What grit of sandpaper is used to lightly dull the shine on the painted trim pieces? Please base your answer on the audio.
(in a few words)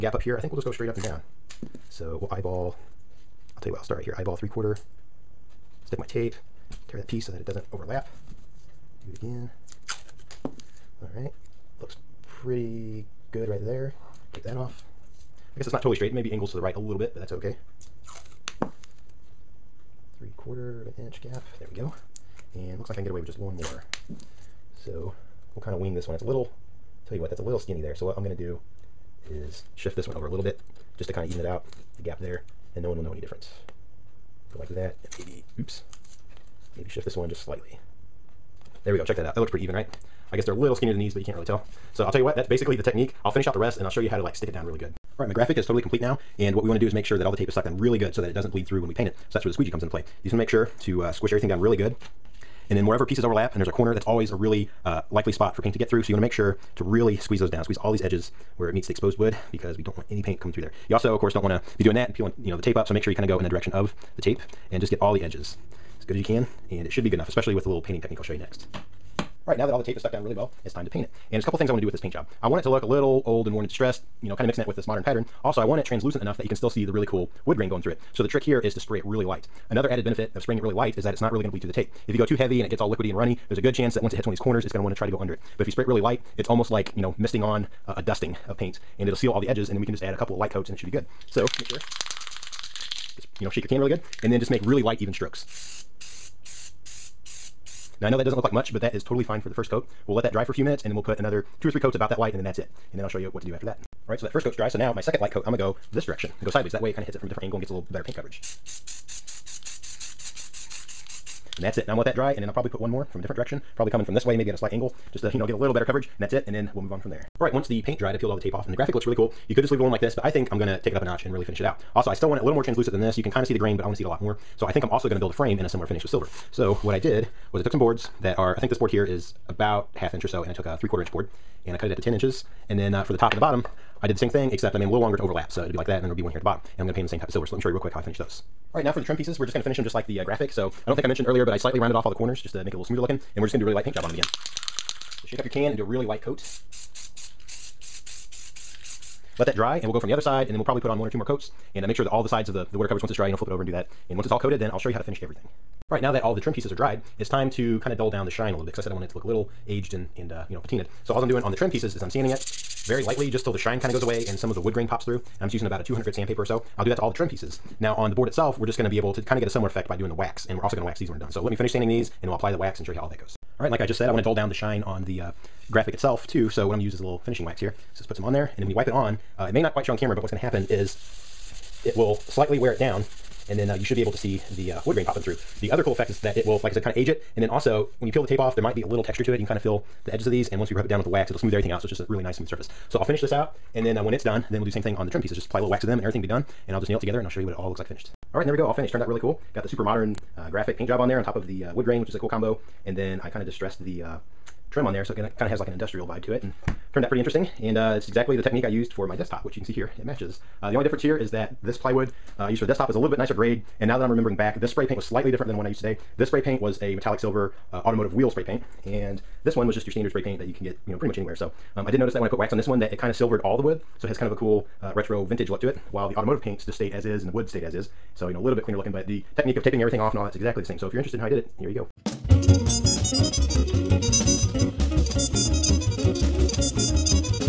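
200 grit.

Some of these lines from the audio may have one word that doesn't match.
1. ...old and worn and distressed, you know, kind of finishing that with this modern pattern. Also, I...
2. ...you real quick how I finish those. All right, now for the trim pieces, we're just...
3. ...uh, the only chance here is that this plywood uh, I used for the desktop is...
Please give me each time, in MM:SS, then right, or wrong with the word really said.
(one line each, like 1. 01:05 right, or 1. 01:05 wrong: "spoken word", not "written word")
1. 01:13 wrong: "mixing", not "finishing"
2. 02:17 right
3. 03:30 wrong: "difference", not "chance".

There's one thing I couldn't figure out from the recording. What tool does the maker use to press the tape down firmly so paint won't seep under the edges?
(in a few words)
Squeegee.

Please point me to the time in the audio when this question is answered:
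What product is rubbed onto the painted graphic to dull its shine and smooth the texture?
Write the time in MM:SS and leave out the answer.
02:57.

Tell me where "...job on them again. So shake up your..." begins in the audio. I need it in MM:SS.
02:23.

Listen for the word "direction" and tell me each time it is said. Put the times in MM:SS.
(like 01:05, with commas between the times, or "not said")
01:03, 01:46, 01:53.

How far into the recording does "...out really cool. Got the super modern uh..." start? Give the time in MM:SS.
03:19.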